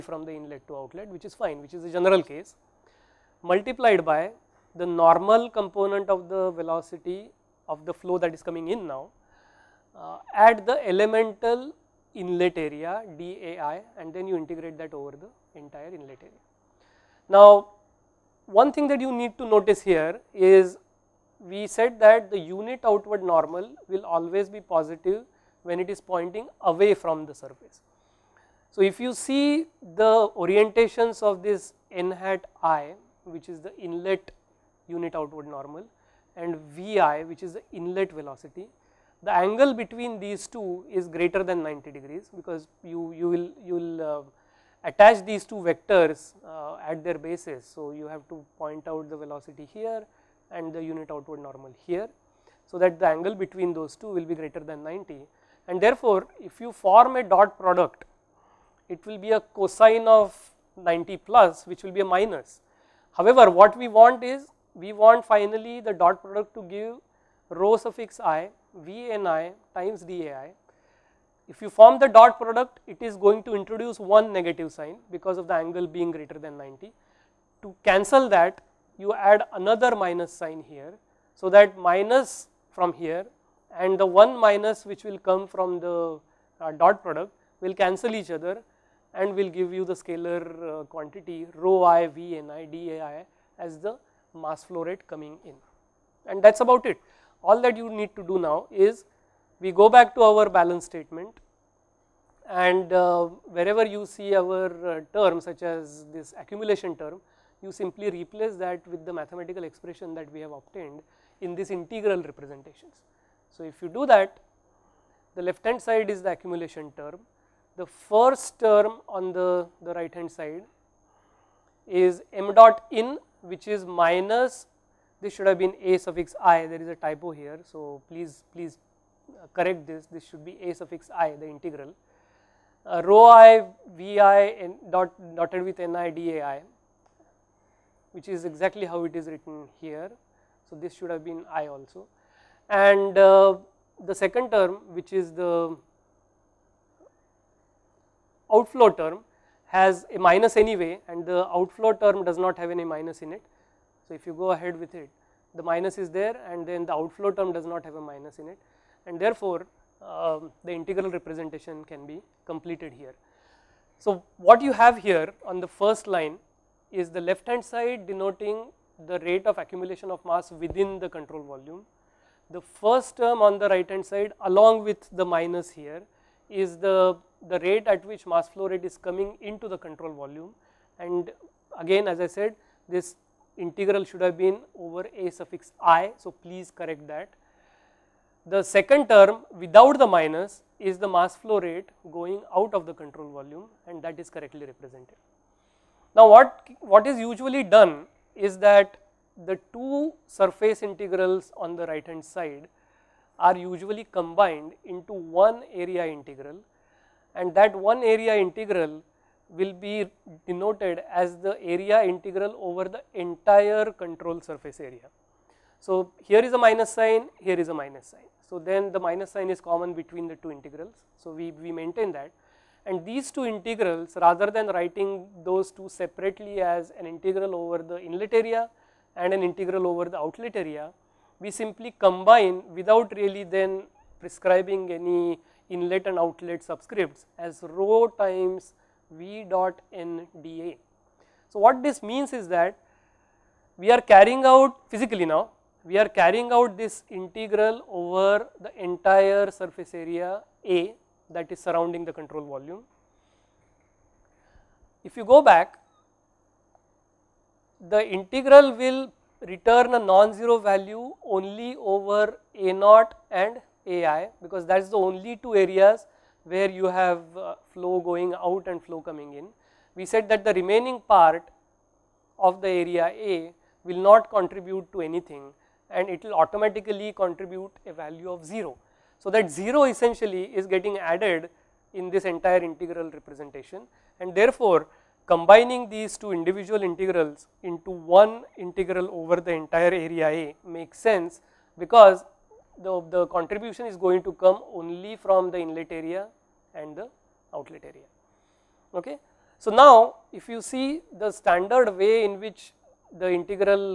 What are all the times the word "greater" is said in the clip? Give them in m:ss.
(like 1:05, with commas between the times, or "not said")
0:41, 0:54, 1:16.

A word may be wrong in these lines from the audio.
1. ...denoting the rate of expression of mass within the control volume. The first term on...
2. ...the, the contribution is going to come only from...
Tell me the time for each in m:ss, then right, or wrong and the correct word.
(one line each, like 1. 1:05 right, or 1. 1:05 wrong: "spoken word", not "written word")
1. 2:48 wrong: "accumulation", not "expression"
2. 4:52 right.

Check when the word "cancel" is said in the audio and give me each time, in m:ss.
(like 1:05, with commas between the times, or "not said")
1:17, 1:27.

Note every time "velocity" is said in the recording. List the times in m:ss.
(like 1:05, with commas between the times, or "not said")
0:06, 0:38, 0:49.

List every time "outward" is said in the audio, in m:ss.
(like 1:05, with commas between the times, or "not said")
0:22, 0:35, 0:51.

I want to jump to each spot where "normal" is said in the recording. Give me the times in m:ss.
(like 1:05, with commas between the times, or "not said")
0:04, 0:23, 0:35, 0:51.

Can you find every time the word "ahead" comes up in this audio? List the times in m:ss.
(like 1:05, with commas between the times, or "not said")
2:34.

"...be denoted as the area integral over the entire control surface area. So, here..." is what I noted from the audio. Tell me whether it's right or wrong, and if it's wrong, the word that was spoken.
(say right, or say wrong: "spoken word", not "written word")
right.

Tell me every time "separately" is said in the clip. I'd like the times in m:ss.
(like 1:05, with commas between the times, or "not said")
3:45.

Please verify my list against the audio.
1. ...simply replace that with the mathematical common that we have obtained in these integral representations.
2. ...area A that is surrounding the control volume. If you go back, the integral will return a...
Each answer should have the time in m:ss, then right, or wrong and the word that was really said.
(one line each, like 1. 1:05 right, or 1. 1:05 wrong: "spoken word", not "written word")
1. 1:47 wrong: "expression", not "common"
2. 4:09 right.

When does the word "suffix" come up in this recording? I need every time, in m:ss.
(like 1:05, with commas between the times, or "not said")
1:07, 2:05, 2:10, 3:05.